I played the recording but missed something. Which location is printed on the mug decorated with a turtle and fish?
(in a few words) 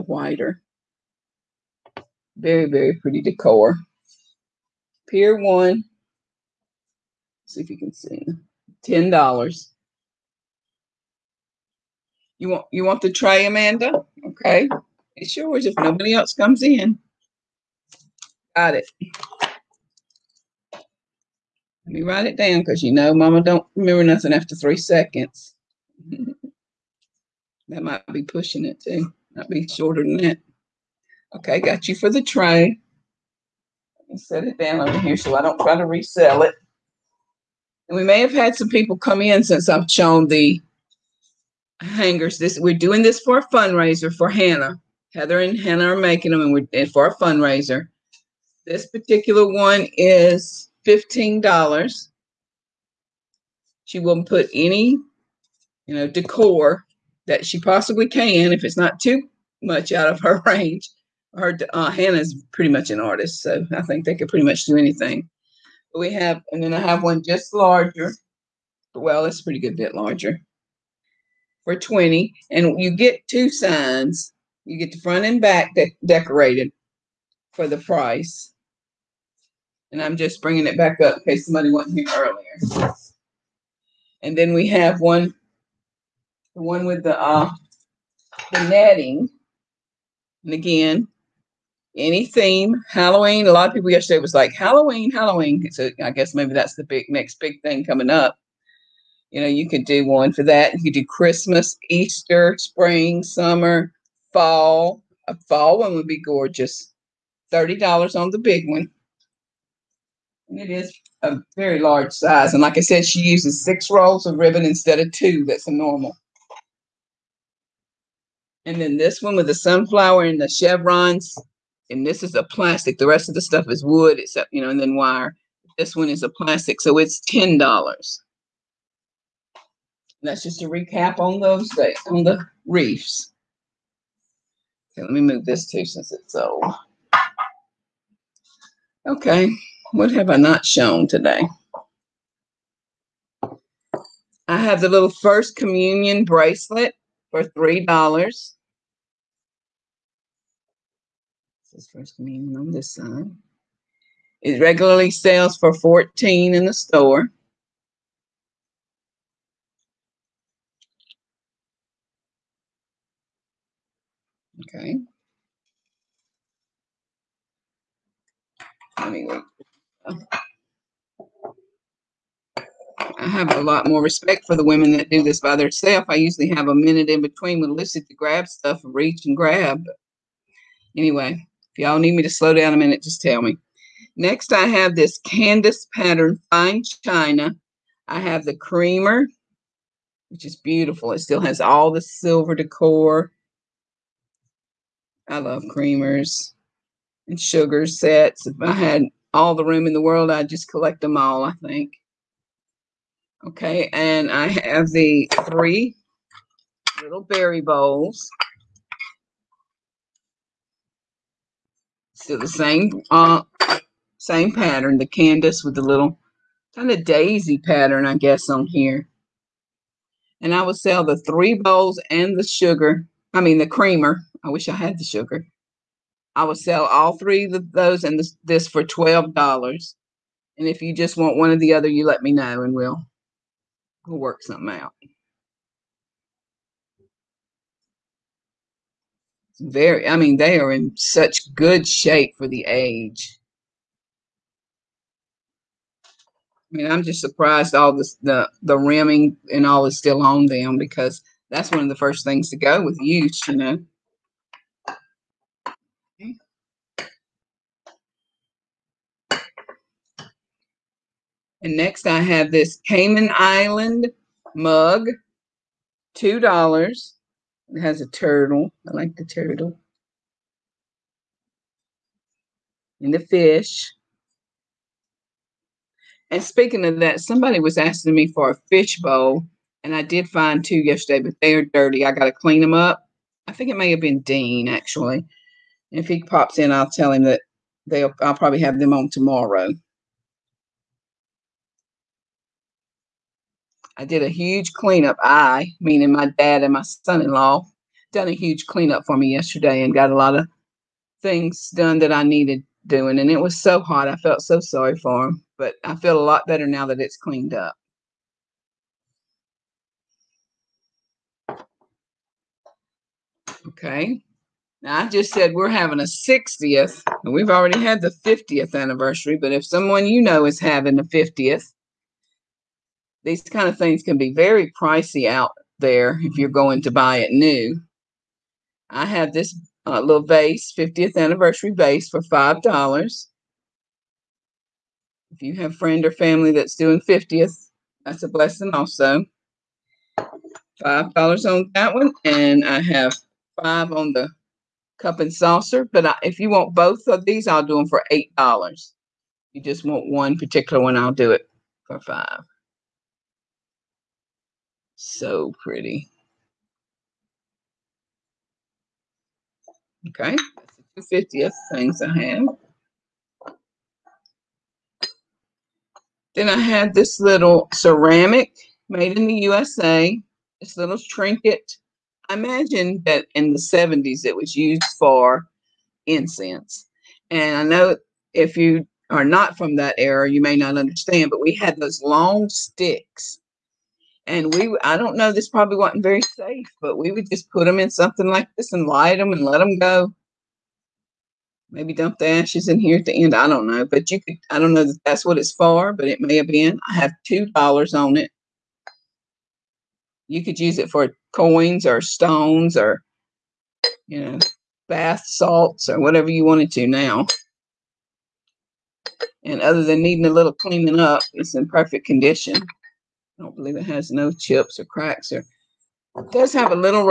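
Cayman Island.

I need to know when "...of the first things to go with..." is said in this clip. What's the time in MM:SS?
04:11.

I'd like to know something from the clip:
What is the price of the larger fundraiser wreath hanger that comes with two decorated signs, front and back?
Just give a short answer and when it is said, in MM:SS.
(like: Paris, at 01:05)
$20, at 01:11.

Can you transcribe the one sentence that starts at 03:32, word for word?
Still the same uh, same pattern, the Candace with the little kind of daisy pattern, I guess, on here.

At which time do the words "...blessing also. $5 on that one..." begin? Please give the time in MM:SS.
05:38.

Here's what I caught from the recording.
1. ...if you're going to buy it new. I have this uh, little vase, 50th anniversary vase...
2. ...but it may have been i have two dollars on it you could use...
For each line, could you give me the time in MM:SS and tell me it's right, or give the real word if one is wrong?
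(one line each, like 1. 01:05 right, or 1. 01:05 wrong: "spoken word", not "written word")
1. 05:26 right
2. 06:35 right.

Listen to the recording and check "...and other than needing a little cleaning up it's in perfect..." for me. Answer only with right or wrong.
right.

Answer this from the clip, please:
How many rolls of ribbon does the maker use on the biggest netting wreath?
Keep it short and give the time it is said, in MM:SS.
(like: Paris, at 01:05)
6, at 01:53.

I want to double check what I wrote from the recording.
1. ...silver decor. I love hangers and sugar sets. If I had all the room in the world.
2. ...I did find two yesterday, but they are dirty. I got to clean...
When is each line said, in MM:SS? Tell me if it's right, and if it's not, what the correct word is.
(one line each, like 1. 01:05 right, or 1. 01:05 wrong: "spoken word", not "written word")
1. 03:12 wrong: "creamers", not "hangers"
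2. 04:39 right.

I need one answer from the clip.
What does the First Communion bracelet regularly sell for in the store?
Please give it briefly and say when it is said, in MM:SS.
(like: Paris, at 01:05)
$14, at 02:35.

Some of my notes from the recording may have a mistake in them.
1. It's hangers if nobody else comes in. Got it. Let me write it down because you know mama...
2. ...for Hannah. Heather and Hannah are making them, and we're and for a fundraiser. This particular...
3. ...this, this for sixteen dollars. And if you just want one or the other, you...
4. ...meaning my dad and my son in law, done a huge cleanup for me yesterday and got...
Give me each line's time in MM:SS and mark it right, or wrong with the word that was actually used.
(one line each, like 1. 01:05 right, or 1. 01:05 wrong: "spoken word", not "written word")
1. 00:15 wrong: "yours", not "hangers"
2. 00:44 right
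3. 03:48 wrong: "twelve", not "sixteen"
4. 04:55 right.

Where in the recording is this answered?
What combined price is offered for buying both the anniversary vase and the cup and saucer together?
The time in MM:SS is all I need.
05:48.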